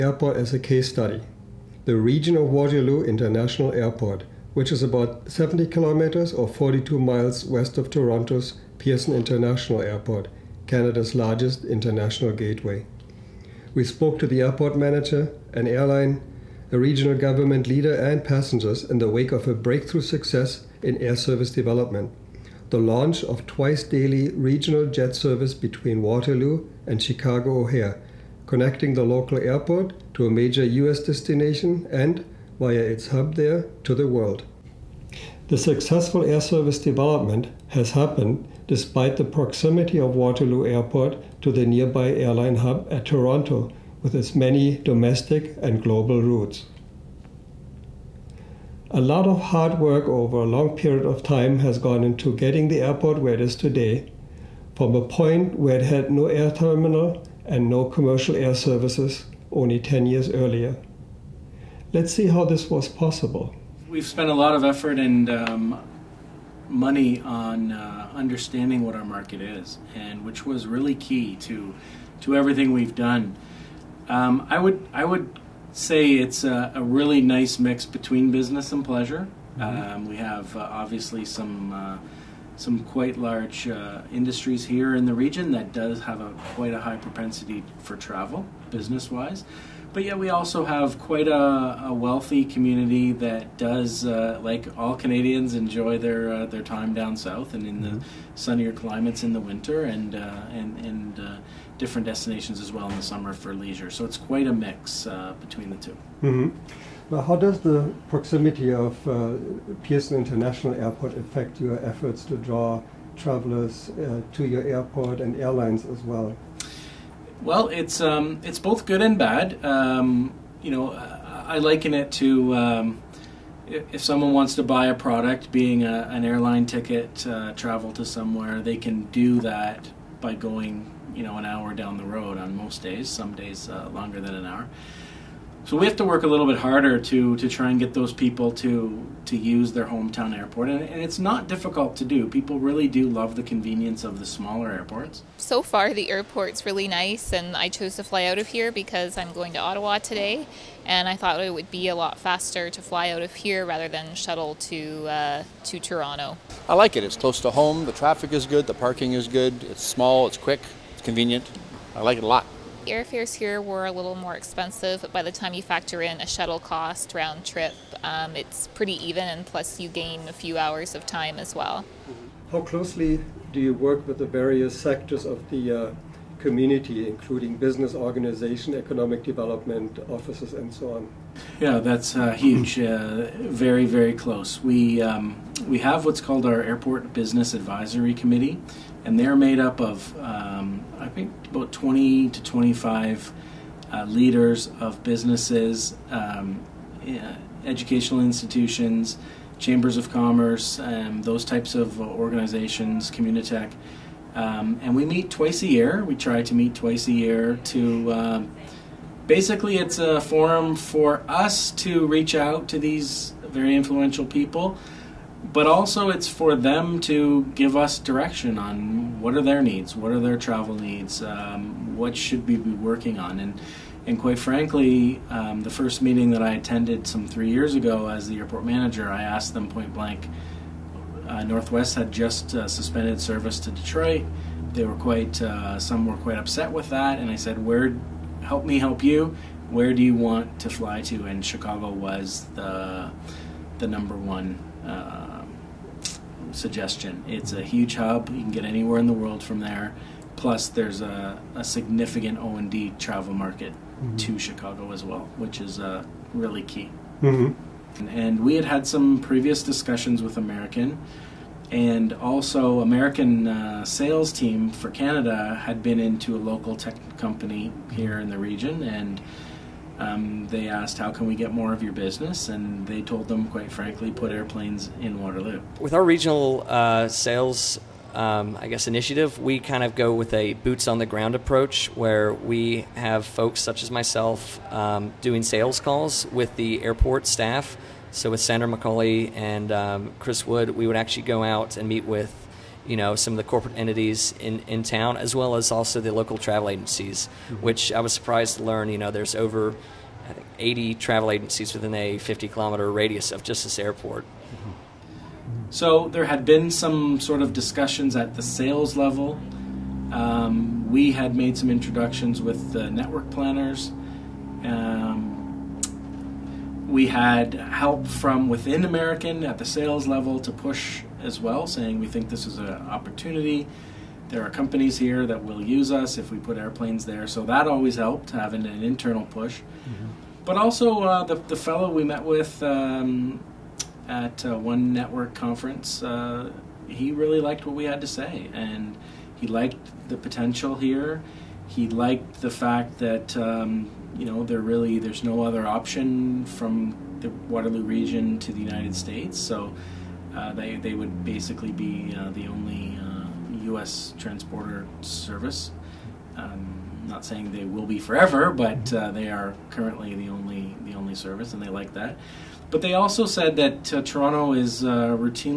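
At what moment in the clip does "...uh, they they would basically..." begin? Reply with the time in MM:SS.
05:50.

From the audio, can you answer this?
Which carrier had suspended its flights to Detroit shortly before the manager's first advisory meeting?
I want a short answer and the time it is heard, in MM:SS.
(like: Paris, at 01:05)
Northwest, at 03:51.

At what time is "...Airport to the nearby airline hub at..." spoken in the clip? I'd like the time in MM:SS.
00:40.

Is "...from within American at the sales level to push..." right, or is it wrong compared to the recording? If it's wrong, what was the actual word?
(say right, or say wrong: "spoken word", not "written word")
right.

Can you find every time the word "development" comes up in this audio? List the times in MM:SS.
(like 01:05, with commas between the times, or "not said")
00:21, 00:36, 02:59.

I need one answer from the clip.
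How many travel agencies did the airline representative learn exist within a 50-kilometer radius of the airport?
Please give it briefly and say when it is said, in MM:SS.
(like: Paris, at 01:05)
80, at 05:00.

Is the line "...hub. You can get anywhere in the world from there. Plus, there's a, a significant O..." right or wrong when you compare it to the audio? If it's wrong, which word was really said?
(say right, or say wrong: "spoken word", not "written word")
right.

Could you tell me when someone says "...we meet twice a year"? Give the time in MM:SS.
03:24.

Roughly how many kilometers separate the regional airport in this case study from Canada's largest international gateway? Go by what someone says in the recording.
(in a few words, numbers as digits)
70.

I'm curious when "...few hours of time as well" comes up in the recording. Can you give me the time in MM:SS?
02:50.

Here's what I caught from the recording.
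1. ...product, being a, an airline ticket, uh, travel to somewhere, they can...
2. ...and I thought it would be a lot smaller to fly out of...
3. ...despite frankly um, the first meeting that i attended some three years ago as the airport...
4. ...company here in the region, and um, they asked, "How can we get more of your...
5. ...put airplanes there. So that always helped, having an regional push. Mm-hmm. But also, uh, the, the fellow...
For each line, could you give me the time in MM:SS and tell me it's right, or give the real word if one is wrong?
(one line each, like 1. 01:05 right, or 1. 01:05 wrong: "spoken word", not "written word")
1. 02:04 right
2. 02:30 wrong: "faster", not "smaller"
3. 03:44 wrong: "quite", not "despite"
4. 04:27 right
5. 05:26 wrong: "internal", not "regional".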